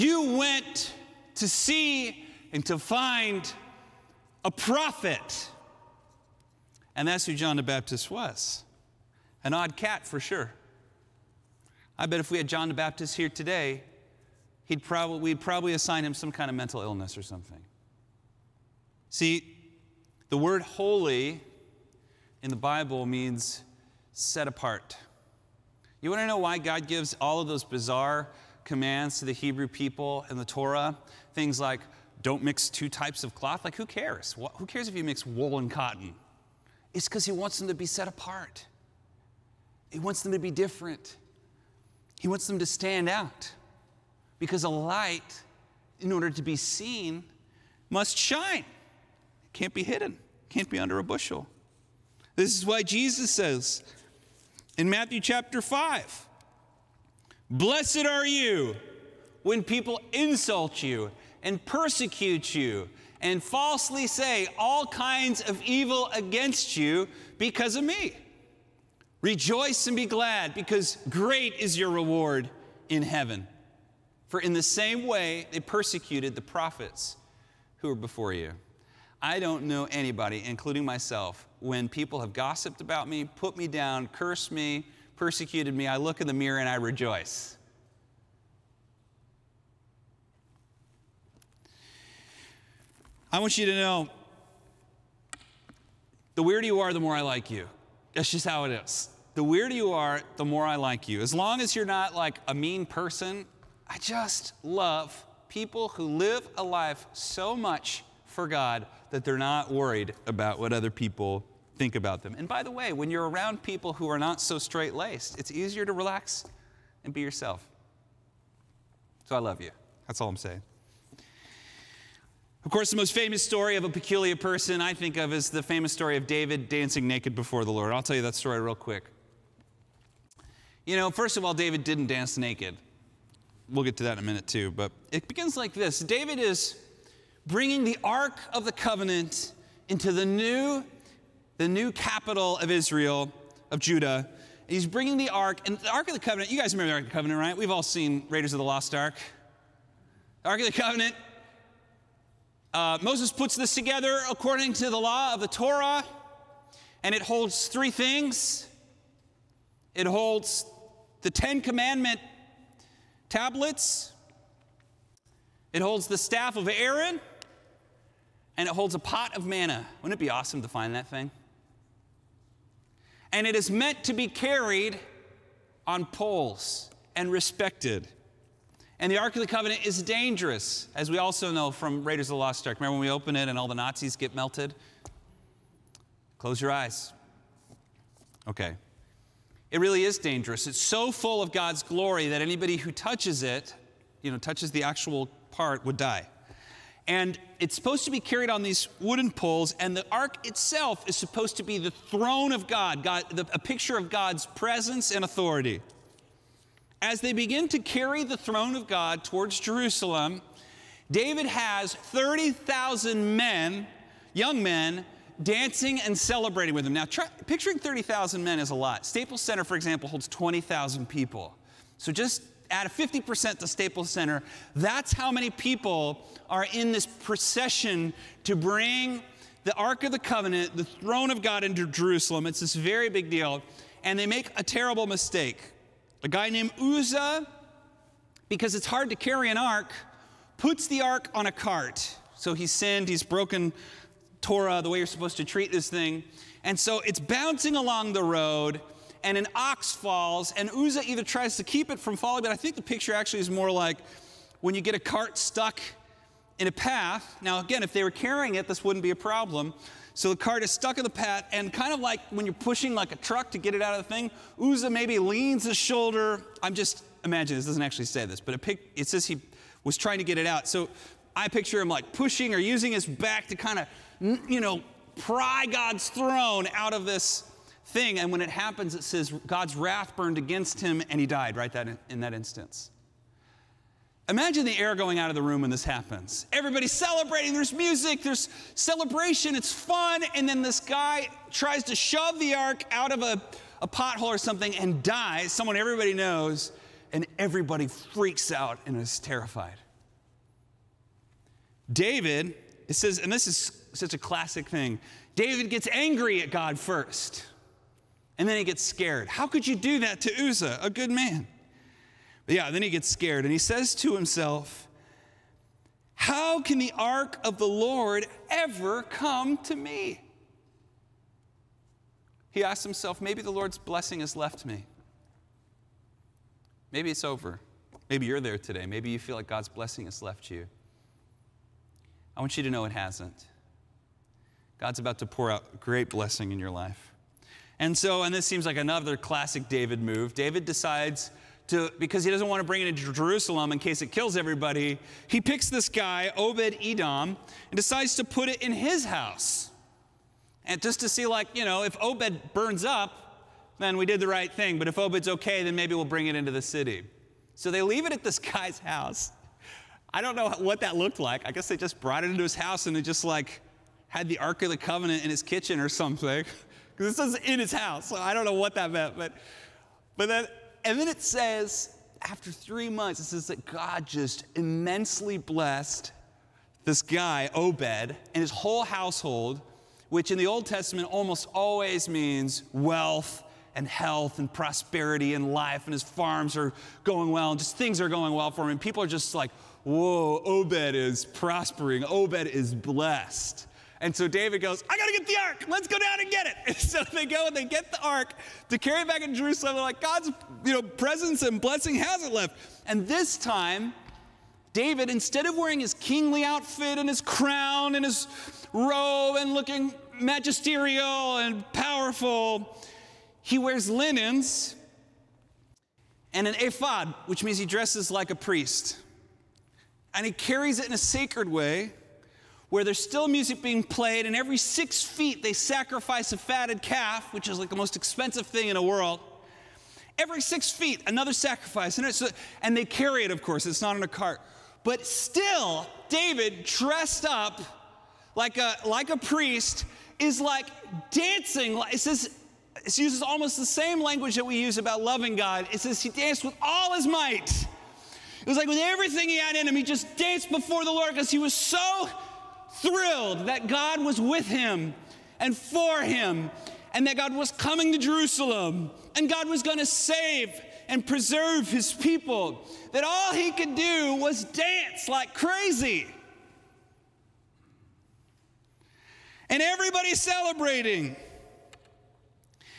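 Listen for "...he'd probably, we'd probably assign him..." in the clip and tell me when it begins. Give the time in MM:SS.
00:14.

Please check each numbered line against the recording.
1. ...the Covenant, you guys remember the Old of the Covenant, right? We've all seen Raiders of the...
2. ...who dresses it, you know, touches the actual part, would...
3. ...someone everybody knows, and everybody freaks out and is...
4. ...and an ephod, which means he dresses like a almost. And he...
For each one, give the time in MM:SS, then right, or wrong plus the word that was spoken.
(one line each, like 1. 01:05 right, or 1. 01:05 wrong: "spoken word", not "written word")
1. 02:26 wrong: "Ark", not "Old"
2. 03:12 wrong: "touches", not "dresses"
3. 04:55 right
4. 06:56 wrong: "priest", not "almost".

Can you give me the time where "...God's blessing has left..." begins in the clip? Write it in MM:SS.
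05:29.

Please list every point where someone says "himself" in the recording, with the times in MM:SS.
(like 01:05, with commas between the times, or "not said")
05:14, 05:22.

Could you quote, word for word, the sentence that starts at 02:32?
Uh, Moses puts this together according to the law of the Torah, and it holds three things.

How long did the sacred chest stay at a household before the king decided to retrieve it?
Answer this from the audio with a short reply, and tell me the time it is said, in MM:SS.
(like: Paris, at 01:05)
3 months, at 06:12.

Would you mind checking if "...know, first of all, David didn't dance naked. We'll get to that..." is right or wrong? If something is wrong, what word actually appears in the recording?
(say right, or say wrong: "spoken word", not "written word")
right.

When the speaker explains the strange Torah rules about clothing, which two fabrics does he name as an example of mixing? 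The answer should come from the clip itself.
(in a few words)
wool and cotton.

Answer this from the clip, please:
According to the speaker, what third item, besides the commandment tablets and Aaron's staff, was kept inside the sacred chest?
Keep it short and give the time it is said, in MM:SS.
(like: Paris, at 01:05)
a pot of manna, at 02:48.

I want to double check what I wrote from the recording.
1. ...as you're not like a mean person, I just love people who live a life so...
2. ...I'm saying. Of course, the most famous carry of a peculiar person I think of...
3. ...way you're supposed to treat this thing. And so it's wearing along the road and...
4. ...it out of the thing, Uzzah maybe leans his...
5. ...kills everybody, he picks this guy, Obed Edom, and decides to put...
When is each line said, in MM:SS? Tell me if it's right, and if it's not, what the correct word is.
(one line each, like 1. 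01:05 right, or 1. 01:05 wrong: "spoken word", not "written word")
1. 01:41 right
2. 02:00 wrong: "story", not "carry"
3. 04:04 wrong: "bouncing", not "wearing"
4. 04:23 right
5. 05:44 right.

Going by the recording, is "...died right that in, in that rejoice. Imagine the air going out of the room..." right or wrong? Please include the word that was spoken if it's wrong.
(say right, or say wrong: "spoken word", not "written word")
wrong: "instance", not "rejoice".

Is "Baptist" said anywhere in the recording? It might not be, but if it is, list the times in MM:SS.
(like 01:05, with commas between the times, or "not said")
00:07, 00:12.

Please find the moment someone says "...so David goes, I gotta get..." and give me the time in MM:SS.
06:34.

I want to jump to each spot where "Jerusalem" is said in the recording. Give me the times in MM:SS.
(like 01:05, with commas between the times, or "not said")
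03:29, 03:51, 05:43, 06:39, 07:37.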